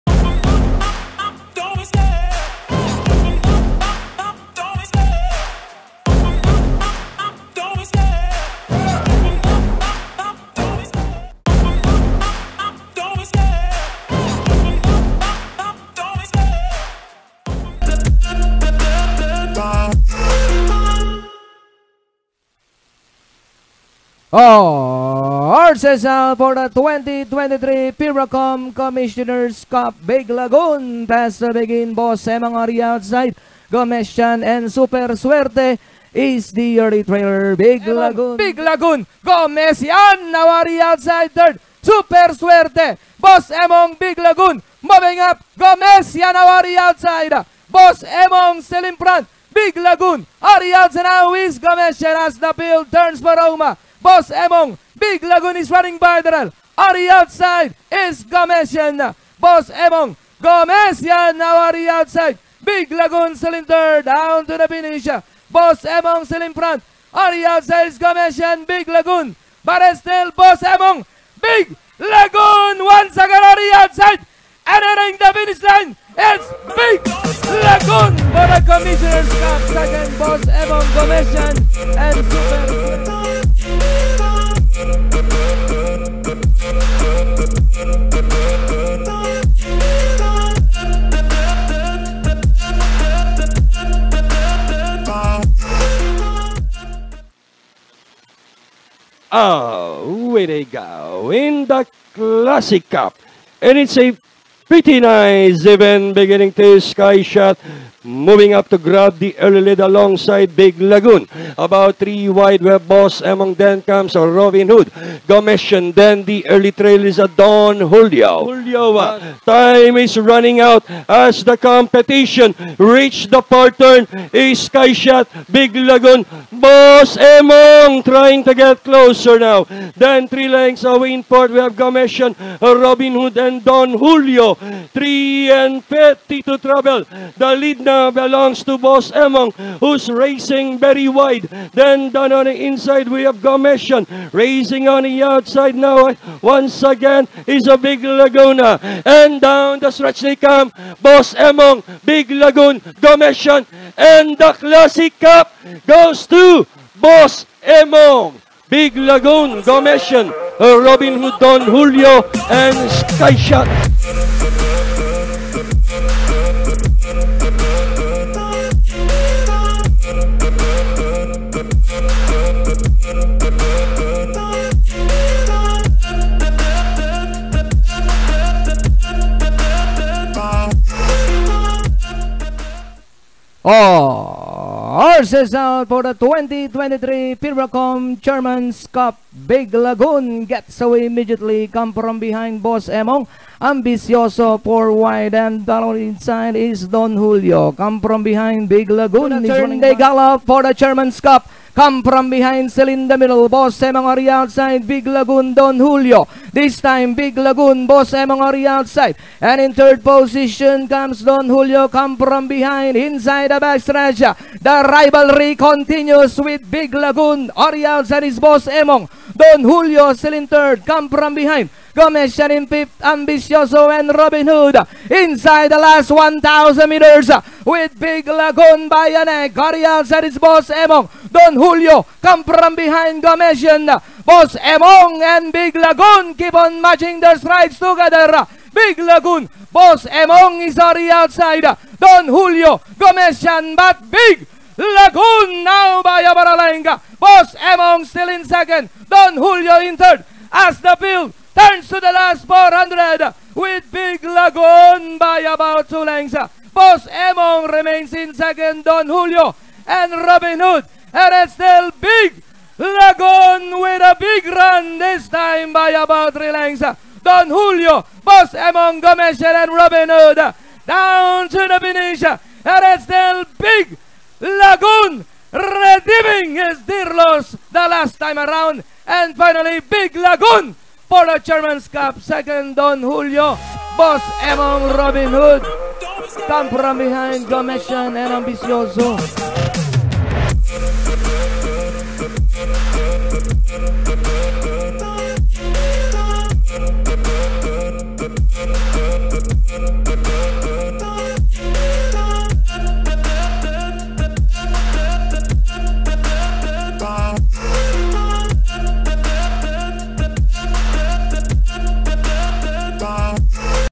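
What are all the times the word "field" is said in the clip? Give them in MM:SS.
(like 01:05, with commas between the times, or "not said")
00:52, 04:10.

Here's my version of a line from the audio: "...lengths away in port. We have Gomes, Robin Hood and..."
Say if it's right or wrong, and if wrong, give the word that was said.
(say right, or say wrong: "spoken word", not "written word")
right.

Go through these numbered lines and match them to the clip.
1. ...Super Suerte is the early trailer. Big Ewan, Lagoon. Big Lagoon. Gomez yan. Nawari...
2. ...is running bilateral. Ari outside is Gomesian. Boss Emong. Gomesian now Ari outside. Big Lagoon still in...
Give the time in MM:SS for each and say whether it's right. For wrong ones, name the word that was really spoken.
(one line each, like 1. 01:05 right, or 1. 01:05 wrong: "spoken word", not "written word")
1. 00:34 right
2. 00:55 right.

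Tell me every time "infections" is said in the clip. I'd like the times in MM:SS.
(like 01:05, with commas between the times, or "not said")
not said.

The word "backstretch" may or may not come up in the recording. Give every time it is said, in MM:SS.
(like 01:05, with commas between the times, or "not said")
03:33.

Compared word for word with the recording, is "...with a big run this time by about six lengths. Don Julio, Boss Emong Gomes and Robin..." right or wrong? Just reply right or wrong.
wrong.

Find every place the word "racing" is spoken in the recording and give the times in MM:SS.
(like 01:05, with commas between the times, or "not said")
02:20, 02:24.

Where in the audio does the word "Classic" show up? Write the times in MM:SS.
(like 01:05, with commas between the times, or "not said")
01:42, 02:34.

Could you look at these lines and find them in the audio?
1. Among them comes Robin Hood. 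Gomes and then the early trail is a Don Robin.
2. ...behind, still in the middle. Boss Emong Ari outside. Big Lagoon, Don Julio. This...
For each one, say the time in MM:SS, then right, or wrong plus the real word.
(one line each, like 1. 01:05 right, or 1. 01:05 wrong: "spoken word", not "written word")
1. 01:53 wrong: "Julio", not "Robin"
2. 03:22 right.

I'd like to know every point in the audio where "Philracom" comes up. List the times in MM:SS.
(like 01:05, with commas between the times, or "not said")
00:27, 03:07.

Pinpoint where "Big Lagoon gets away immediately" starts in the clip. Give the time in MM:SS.
03:09.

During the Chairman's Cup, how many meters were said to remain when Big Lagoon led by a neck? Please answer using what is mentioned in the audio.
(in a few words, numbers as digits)
1,000.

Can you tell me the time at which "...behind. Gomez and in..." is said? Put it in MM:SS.
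03:41.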